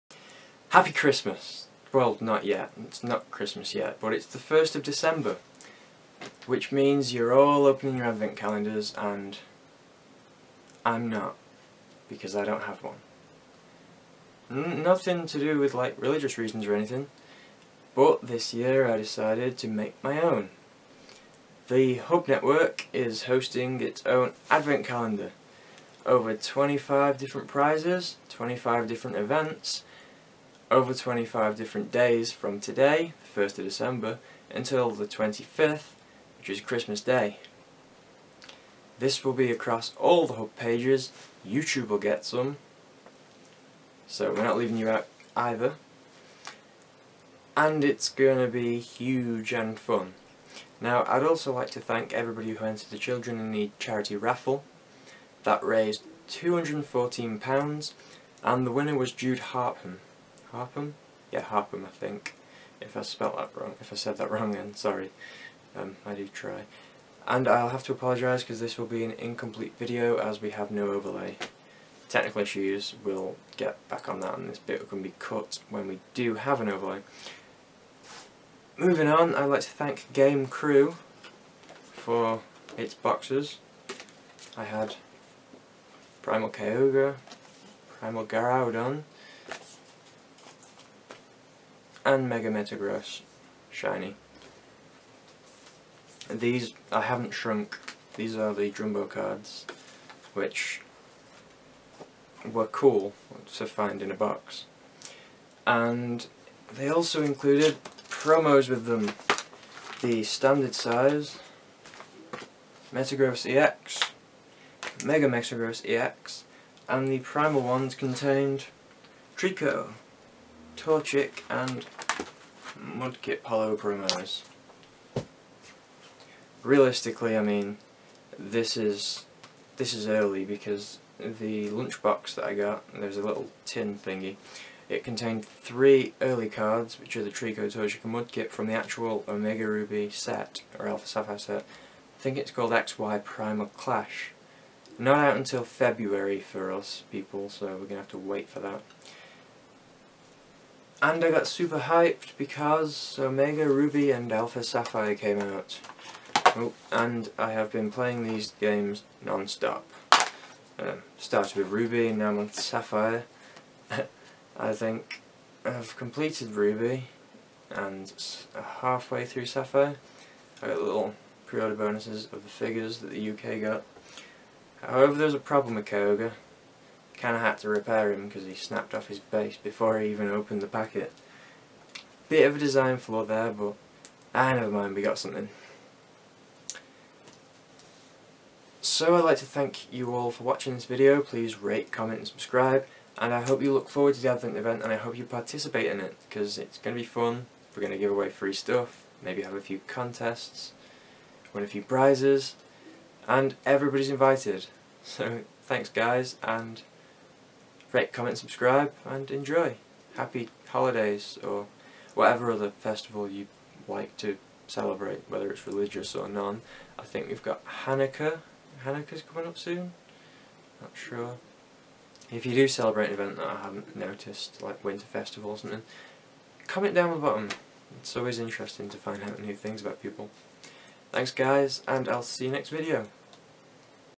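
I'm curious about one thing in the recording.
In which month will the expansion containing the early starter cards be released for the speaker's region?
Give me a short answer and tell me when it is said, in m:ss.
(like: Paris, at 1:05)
February, at 2:25.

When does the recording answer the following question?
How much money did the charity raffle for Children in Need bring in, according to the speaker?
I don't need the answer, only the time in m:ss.
0:56.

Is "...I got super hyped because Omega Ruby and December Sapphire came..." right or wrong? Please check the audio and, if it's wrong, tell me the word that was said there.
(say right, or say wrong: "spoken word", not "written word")
wrong: "Alpha", not "December".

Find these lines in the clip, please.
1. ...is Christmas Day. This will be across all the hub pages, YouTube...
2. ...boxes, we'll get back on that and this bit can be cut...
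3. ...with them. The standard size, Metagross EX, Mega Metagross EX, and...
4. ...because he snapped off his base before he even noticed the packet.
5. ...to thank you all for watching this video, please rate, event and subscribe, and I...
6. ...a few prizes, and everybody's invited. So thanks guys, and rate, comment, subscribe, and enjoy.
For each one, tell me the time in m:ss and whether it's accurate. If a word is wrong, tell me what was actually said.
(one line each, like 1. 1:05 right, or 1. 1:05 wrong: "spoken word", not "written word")
1. 0:36 right
2. 1:12 wrong: "issues", not "boxes"
3. 1:48 right
4. 2:58 wrong: "opened", not "noticed"
5. 3:09 wrong: "comment", not "event"
6. 3:21 right.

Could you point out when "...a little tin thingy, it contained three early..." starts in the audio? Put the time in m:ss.
2:13.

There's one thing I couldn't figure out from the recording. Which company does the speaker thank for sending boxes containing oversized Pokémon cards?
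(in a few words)
Game Crew.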